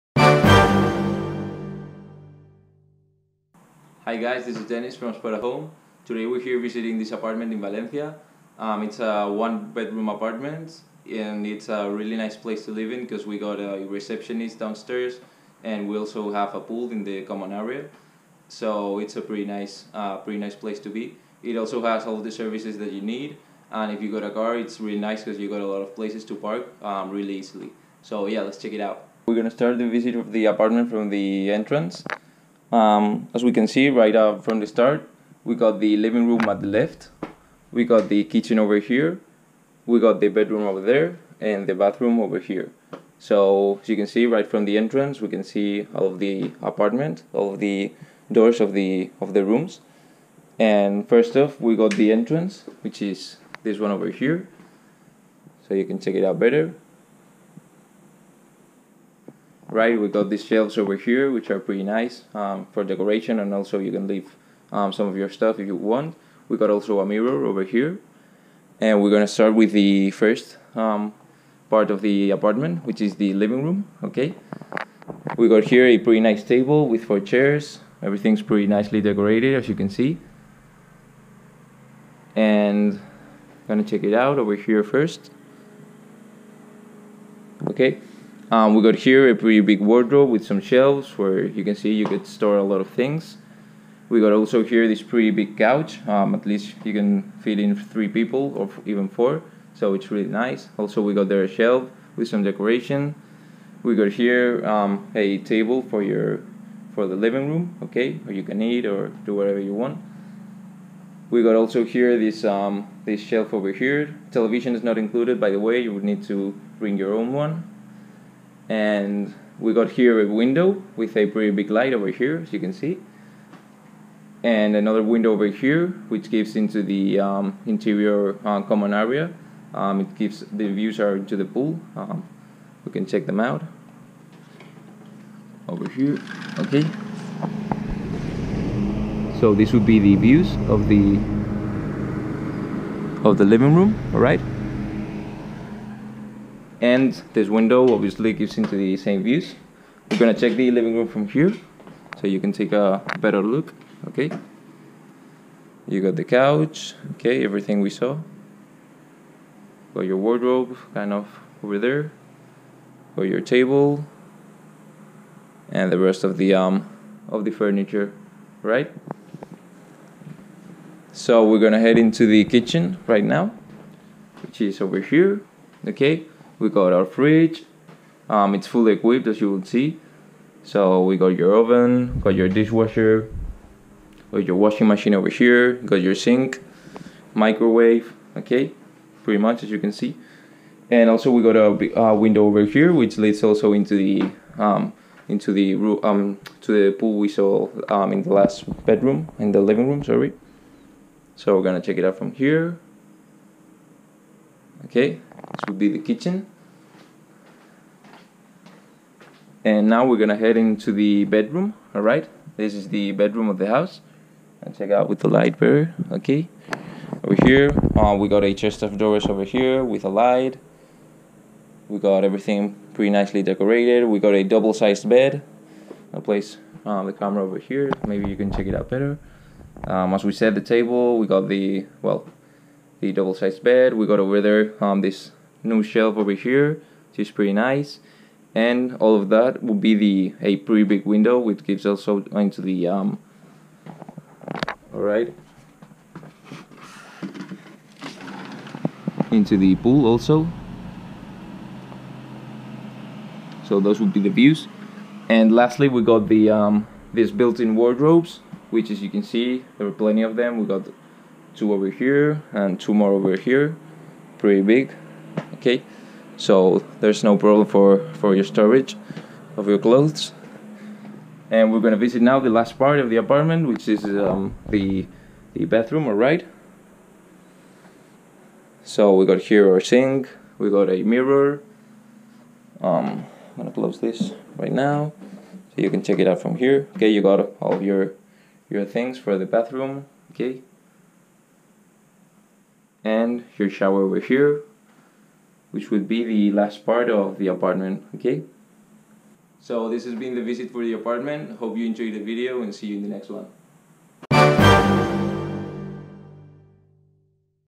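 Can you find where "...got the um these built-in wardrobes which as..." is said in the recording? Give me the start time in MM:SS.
04:16.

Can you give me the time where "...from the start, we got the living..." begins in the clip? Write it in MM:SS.
00:34.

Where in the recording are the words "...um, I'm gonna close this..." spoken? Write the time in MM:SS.
04:42.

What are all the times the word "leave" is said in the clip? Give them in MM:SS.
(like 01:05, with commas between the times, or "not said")
01:04.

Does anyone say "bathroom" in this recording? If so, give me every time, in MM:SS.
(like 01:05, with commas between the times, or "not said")
00:41, 04:35, 04:49.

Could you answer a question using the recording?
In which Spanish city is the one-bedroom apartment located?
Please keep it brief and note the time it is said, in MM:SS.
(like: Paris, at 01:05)
Valencia, at 00:07.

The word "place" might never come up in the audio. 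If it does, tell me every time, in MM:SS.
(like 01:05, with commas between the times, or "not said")
00:12, 00:20, 00:25, 03:46.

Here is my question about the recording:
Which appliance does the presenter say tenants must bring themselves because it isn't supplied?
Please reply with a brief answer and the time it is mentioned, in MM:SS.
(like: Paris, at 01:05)
Television, at 01:54.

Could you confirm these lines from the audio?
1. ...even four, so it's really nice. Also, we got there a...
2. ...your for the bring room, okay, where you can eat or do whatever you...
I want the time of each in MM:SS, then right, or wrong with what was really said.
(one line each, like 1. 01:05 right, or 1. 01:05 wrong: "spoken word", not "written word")
1. 01:38 right
2. 01:46 wrong: "living", not "bring".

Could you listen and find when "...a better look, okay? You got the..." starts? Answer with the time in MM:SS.
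02:32.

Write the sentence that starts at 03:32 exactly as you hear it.
This is the bedroom of the house.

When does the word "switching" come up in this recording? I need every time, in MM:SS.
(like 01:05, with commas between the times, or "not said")
not said.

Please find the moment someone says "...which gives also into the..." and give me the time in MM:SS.
04:01.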